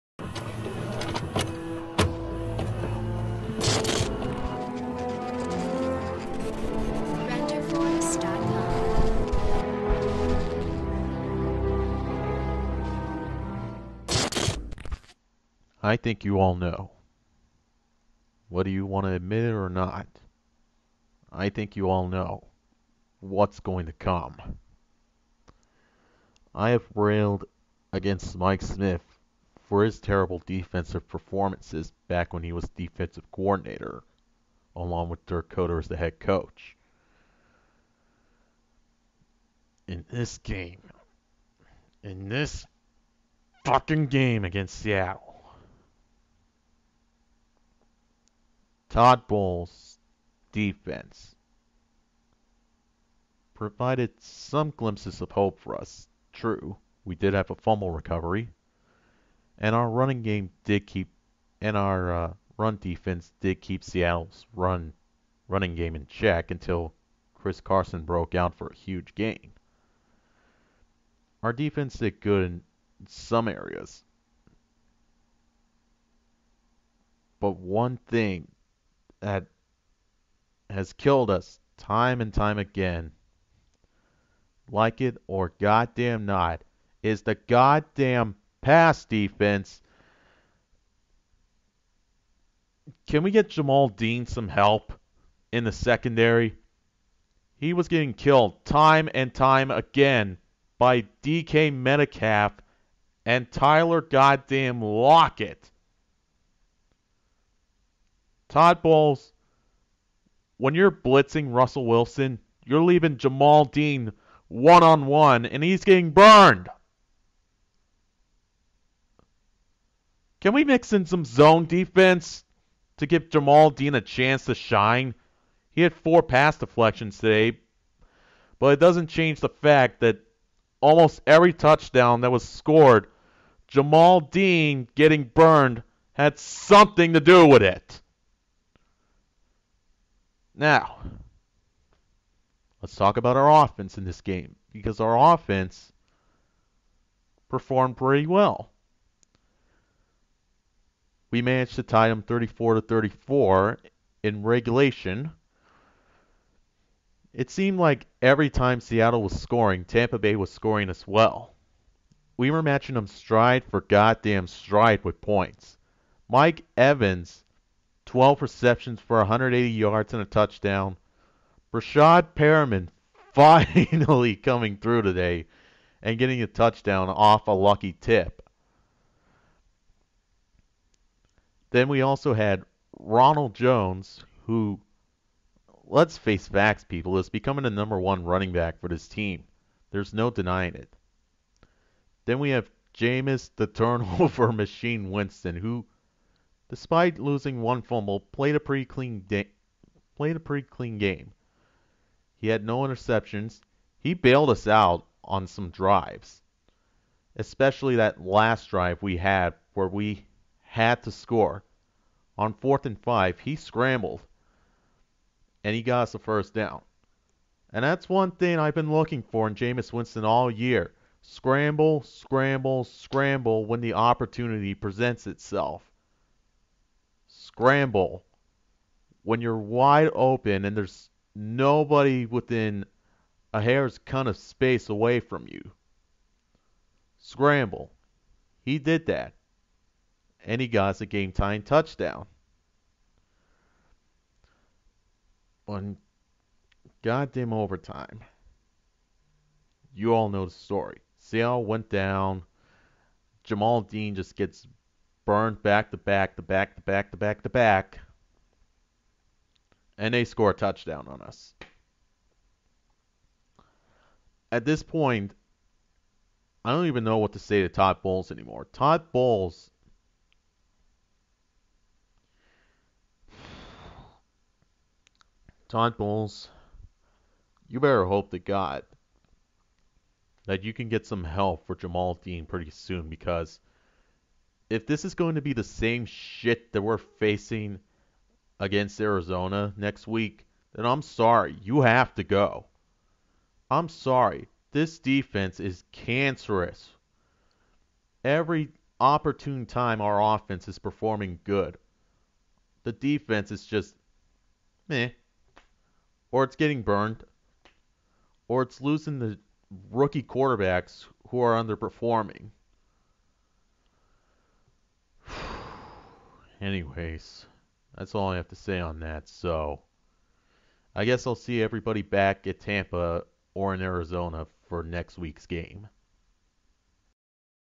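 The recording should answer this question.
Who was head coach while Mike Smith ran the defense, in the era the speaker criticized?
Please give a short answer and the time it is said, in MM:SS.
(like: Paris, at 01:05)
Dirk Koetter, at 00:35.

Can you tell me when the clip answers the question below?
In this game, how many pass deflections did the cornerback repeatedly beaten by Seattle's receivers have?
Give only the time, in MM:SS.
02:05.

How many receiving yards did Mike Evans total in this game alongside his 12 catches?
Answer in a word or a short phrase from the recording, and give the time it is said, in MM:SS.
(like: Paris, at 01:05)
180, at 02:49.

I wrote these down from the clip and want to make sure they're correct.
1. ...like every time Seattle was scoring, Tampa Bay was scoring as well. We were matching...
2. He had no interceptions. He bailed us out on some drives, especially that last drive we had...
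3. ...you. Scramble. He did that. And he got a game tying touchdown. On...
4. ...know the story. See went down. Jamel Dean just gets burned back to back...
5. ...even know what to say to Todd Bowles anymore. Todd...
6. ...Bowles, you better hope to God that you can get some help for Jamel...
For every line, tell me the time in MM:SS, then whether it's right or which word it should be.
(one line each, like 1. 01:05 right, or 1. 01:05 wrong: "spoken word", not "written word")
1. 02:37 right
2. 03:22 right
3. 03:55 right
4. 04:10 right
5. 04:26 right
6. 04:35 right.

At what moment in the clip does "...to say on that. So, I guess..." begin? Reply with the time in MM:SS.
05:18.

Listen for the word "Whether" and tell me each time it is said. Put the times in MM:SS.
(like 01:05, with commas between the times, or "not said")
00:18.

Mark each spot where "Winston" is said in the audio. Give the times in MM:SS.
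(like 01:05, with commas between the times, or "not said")
03:15, 03:39.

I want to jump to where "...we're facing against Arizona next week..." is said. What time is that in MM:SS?
04:46.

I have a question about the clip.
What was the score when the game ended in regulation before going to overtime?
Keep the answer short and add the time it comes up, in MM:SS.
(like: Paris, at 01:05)
34 to 34, at 02:32.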